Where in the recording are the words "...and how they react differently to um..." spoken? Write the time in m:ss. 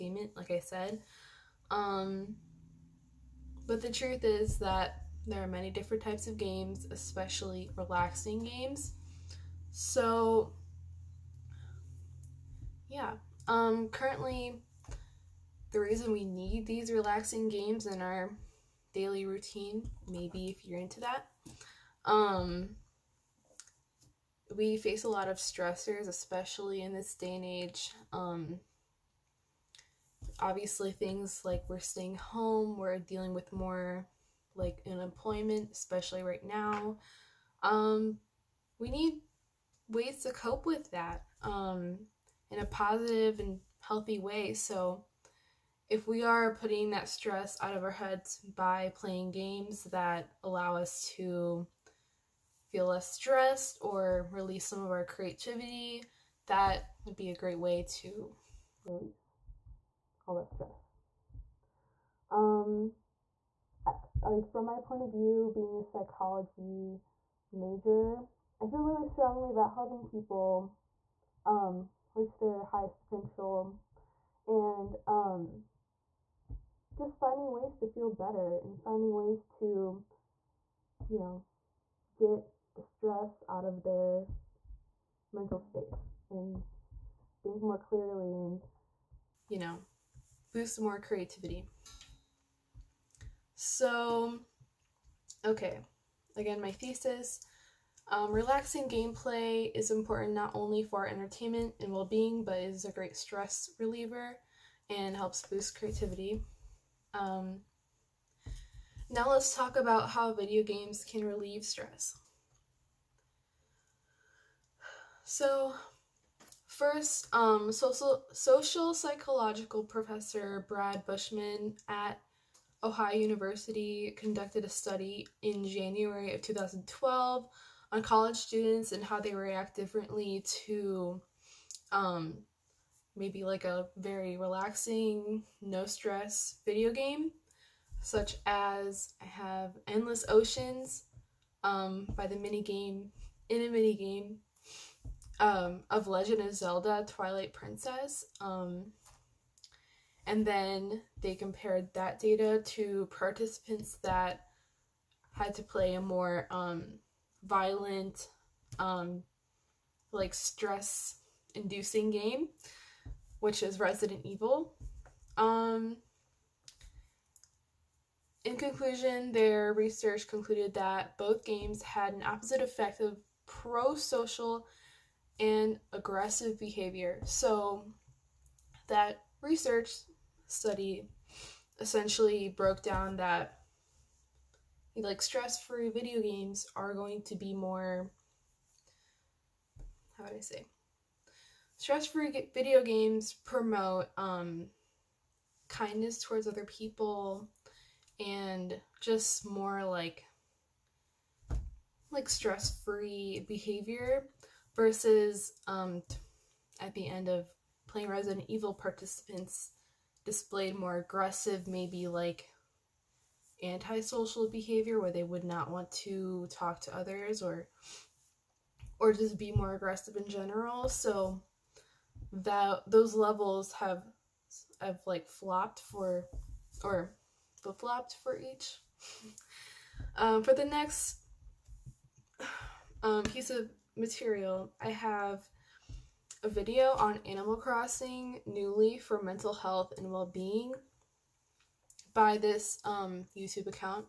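2:08.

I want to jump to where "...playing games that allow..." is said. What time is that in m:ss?
0:48.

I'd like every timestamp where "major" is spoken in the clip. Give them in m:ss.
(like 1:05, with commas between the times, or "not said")
1:07.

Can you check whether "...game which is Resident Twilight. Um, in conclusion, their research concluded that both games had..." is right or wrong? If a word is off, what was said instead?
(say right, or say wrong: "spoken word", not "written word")
wrong: "Evil", not "Twilight".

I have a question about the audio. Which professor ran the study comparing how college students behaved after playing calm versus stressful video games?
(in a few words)
Brad Bushman.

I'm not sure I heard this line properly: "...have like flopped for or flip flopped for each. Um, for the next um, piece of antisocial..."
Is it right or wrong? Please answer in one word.
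wrong.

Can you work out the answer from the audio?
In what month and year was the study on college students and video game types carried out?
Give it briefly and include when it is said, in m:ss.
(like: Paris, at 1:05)
January 2012, at 2:05.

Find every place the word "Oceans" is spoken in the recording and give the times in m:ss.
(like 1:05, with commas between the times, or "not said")
2:20.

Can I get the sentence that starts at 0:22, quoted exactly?
Um, we face a lot of stressors, especially in this day and age.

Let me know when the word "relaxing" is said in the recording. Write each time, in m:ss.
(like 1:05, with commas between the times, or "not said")
0:07, 0:16, 1:38, 2:14.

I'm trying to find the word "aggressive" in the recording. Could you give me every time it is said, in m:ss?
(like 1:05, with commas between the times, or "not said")
2:55, 3:30, 3:39.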